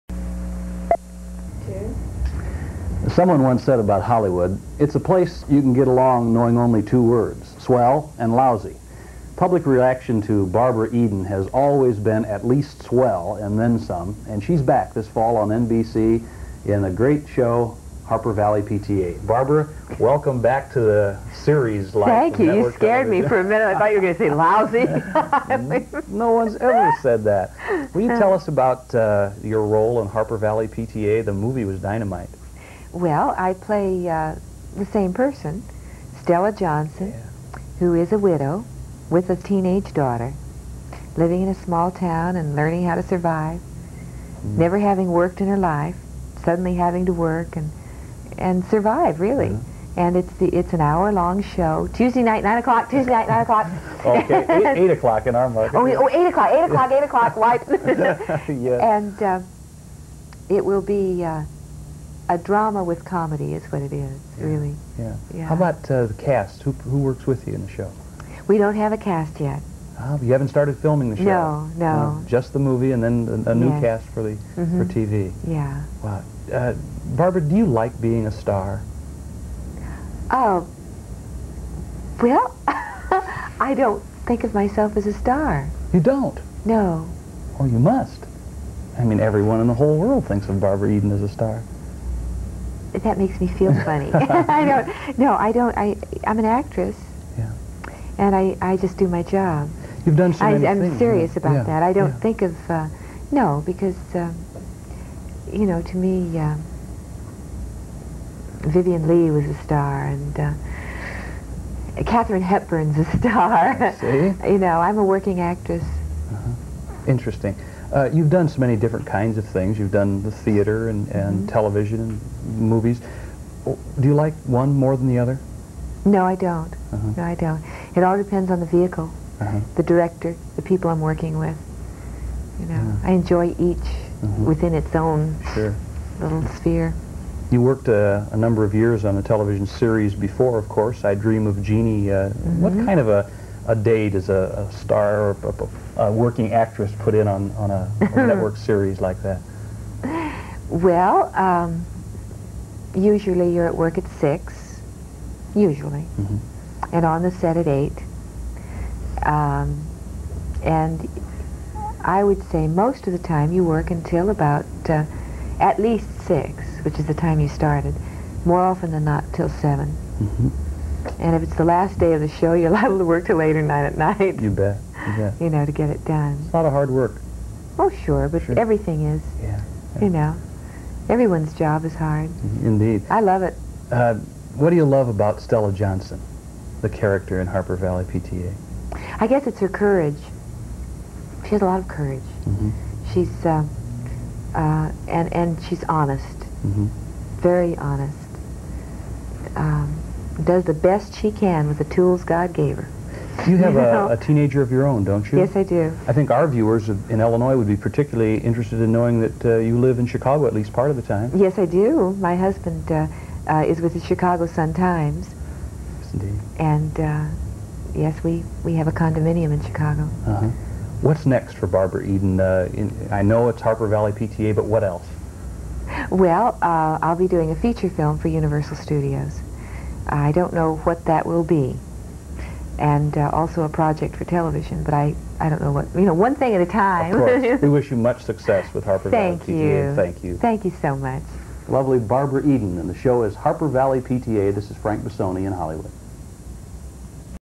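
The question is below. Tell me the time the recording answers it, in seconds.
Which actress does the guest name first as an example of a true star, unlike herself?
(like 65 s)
108 s.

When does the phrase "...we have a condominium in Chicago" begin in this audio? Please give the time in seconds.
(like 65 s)
218 s.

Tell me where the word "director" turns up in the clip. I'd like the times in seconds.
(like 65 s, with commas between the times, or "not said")
129 s.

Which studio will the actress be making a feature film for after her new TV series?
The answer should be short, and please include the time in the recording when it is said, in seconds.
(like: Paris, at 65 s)
Universal Studios, at 228 s.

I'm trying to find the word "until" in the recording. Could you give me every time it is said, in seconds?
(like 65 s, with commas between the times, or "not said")
163 s.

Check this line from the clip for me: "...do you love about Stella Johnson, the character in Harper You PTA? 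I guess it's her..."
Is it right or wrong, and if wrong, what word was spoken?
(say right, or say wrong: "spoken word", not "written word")
wrong: "Valley", not "You".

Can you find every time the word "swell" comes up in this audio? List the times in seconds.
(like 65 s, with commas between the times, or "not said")
7 s, 12 s.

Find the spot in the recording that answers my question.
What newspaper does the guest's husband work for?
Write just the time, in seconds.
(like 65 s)
214 s.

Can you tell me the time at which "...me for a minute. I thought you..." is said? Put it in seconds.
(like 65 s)
23 s.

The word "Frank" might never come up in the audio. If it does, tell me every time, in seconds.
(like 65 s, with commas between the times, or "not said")
244 s.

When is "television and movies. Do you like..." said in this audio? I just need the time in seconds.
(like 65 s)
121 s.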